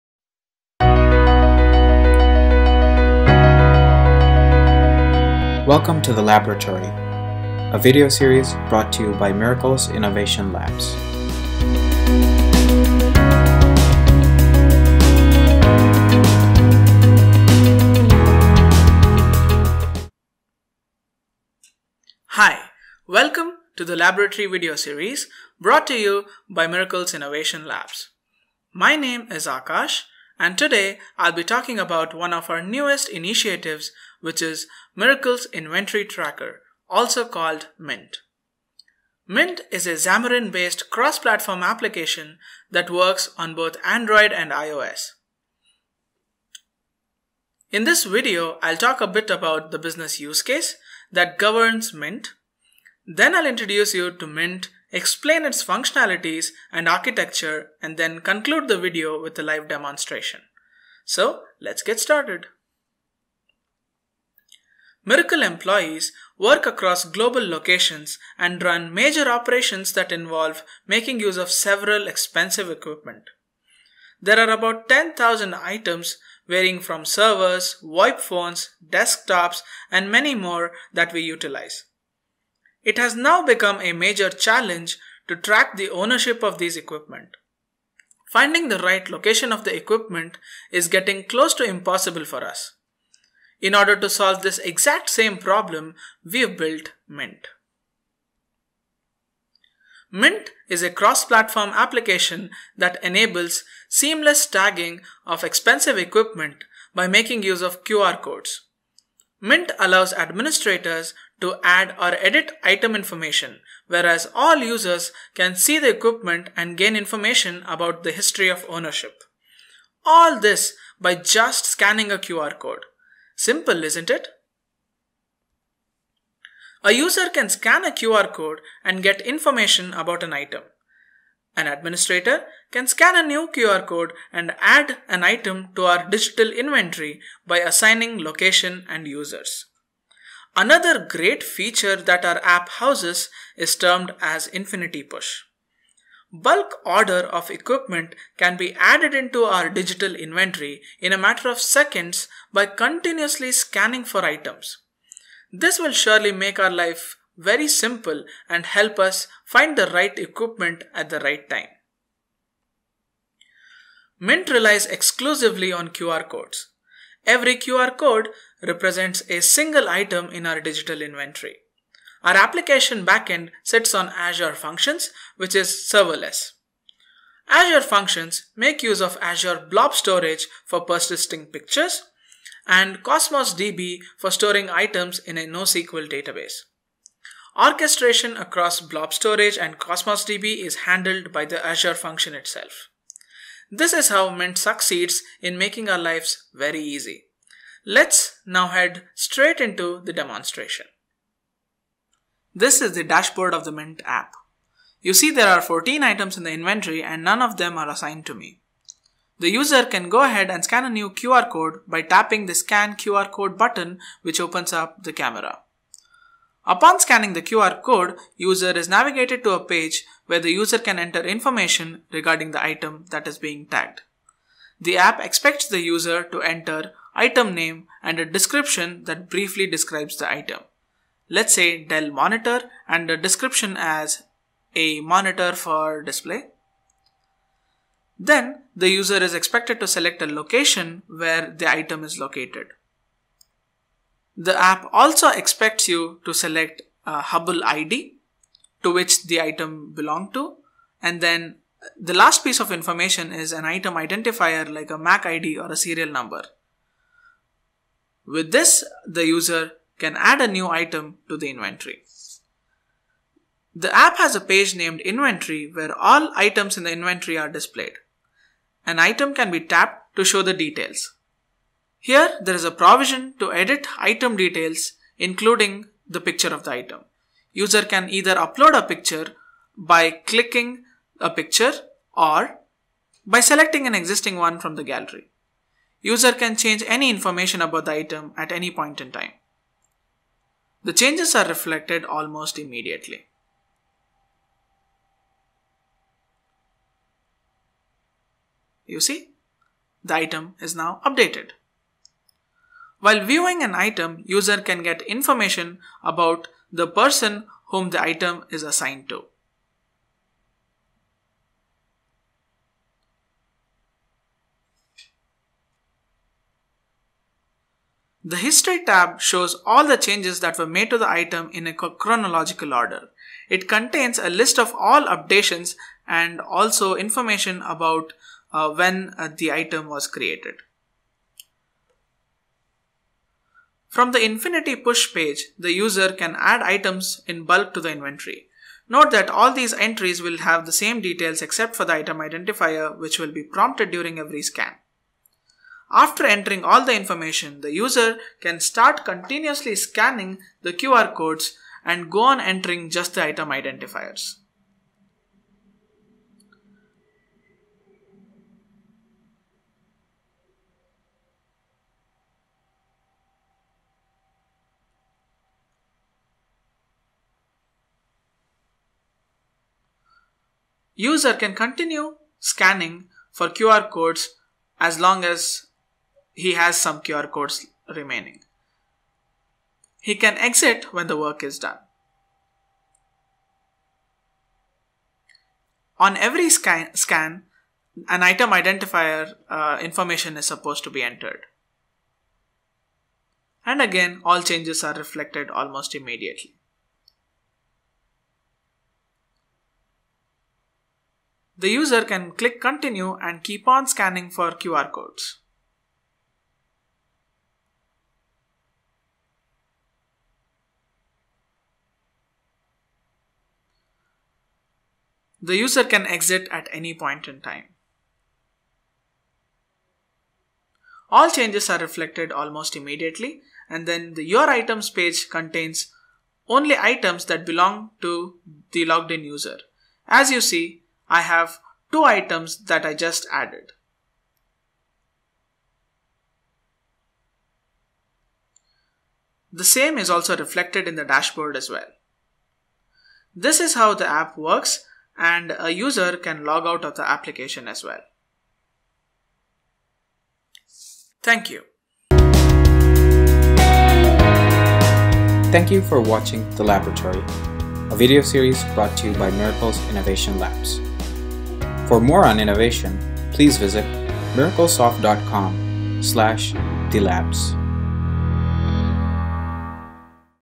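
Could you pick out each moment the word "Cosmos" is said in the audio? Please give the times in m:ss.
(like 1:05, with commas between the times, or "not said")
3:03, 3:09.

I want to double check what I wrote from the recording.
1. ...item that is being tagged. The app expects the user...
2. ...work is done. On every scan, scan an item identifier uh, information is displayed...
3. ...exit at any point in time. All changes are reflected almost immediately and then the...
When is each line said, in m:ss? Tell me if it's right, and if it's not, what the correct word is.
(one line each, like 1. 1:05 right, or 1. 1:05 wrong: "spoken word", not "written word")
1. 3:42 right
2. 6:21 wrong: "supposed", not "displayed"
3. 6:56 right.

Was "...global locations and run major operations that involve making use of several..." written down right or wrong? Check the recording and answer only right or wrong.
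right.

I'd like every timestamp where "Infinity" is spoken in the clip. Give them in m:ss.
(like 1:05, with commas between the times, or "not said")
2:24, 5:34.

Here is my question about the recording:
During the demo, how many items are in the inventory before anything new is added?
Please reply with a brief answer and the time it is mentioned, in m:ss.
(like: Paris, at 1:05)
14, at 3:25.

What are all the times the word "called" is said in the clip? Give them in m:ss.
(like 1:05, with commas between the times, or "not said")
0:37.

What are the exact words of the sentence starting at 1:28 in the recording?
Finding the right location of the equipment is getting close to impossible for us.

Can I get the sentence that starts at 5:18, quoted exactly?
The History tab shows all the changes that were made to the item in a chronological order.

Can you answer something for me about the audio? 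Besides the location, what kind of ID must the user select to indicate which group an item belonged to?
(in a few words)
Hubble ID.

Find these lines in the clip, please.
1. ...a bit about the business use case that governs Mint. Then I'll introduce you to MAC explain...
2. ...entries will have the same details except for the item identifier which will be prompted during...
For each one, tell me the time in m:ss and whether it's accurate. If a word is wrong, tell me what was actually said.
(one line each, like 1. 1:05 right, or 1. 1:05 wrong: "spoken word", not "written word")
1. 0:48 wrong: "Mint", not "MAC"
2. 5:39 right.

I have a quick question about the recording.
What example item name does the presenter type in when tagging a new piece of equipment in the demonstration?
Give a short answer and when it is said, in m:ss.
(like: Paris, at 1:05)
Dell monitor, at 3:51.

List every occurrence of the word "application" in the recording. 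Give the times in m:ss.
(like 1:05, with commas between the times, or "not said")
0:41, 1:41, 2:52, 7:27.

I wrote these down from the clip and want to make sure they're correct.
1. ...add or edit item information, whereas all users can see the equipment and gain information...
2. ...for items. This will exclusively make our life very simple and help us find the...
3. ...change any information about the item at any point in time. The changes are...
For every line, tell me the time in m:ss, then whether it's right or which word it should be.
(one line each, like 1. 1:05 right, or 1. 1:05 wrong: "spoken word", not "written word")
1. 1:51 right
2. 2:34 wrong: "surely", not "exclusively"
3. 4:46 right.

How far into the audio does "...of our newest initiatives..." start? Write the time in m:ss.
0:32.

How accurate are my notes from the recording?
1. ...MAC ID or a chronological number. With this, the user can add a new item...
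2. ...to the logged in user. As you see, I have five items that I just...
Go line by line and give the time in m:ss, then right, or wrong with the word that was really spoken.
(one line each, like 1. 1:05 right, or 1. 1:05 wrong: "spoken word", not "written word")
1. 4:14 wrong: "serial", not "chronological"
2. 7:08 wrong: "two", not "five".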